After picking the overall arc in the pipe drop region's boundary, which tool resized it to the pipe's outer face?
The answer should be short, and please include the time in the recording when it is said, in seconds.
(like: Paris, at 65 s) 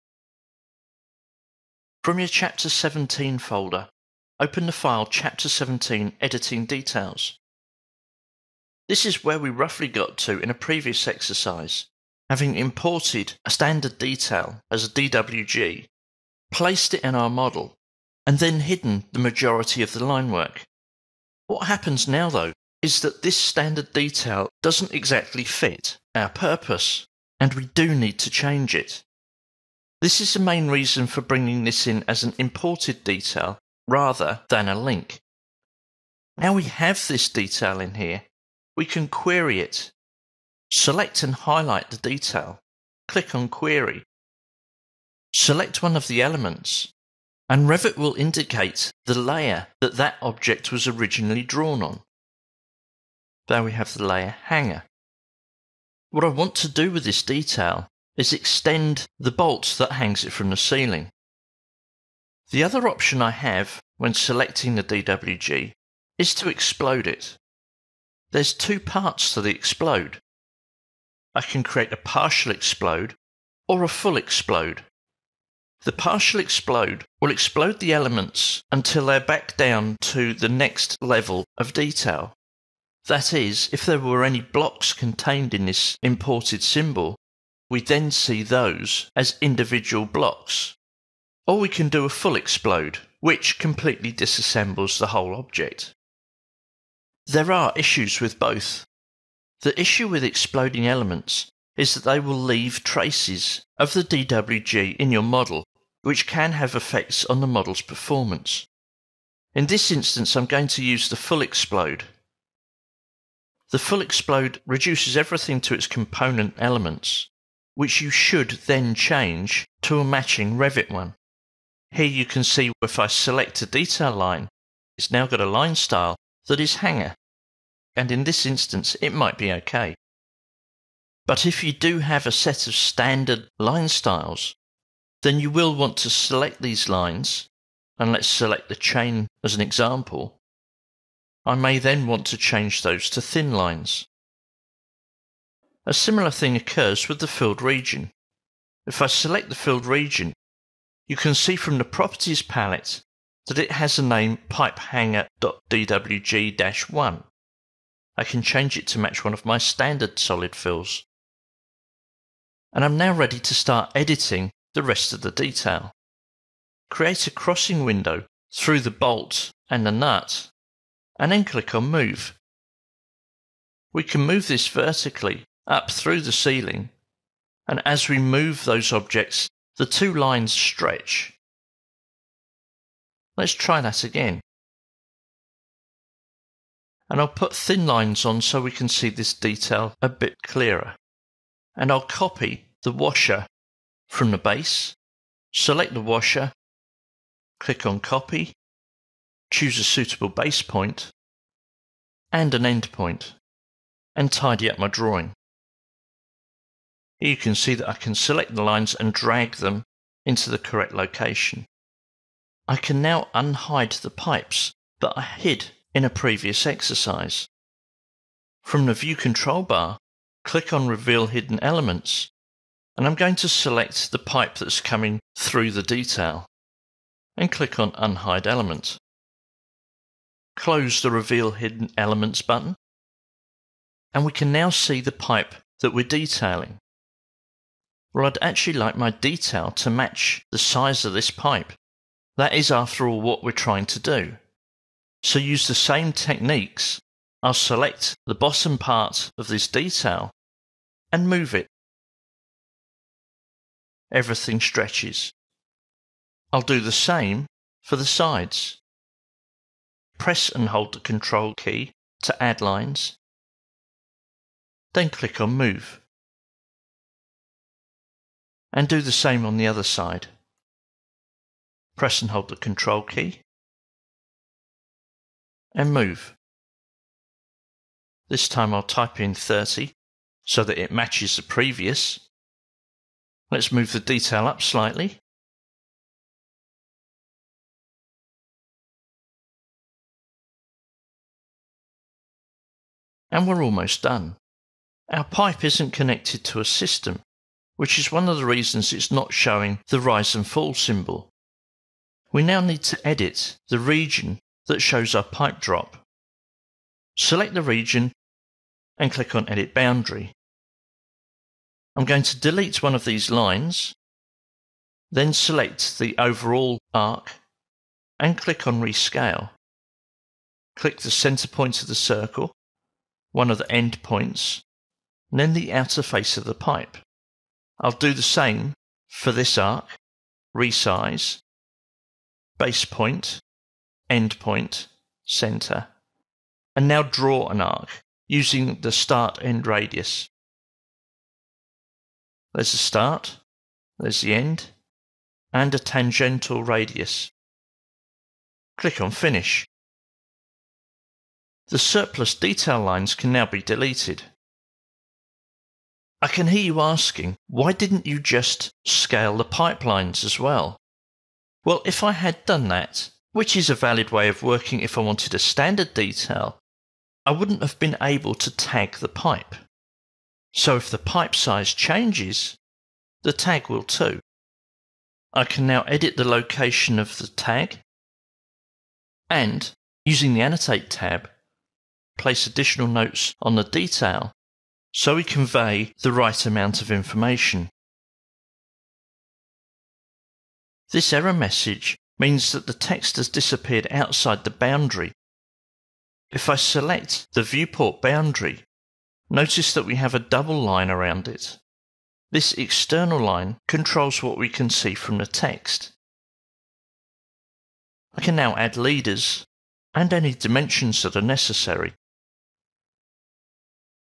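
Rescale, at 318 s.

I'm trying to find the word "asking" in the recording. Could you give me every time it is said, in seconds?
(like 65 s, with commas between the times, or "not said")
356 s.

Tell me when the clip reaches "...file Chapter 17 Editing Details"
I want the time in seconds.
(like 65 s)
4 s.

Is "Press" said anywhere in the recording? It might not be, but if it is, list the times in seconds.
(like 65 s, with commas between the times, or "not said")
260 s, 271 s.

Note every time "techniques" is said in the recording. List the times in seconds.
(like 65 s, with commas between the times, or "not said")
246 s.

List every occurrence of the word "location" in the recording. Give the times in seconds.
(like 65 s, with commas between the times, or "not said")
210 s, 376 s.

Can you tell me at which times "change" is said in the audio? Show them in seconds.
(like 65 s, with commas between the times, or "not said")
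28 s, 118 s, 142 s, 158 s, 371 s.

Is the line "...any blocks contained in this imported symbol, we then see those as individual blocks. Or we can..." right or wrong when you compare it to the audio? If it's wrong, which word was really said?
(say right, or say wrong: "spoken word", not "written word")
right.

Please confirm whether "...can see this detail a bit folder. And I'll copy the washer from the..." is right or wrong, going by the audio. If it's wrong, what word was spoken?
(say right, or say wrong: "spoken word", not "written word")
wrong: "clearer", not "folder".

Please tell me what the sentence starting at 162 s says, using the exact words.
And I'm now ready to start editing the rest of the detail.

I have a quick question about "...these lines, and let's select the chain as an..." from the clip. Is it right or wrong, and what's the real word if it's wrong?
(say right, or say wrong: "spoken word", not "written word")
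right.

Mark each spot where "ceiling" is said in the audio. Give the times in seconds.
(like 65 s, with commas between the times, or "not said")
60 s, 176 s.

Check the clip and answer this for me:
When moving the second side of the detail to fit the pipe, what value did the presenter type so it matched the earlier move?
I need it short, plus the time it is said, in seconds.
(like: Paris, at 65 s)
30, at 279 s.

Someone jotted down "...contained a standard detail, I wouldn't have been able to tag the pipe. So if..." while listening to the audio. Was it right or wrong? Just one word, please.
wrong.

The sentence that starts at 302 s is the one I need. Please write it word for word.
We now need to edit the region that shows our pipe drop.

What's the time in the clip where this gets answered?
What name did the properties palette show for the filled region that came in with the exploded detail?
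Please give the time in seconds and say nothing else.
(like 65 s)
154 s.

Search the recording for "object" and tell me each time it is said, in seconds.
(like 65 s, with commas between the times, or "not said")
50 s, 95 s, 178 s.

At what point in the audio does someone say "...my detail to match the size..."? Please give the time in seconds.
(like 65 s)
238 s.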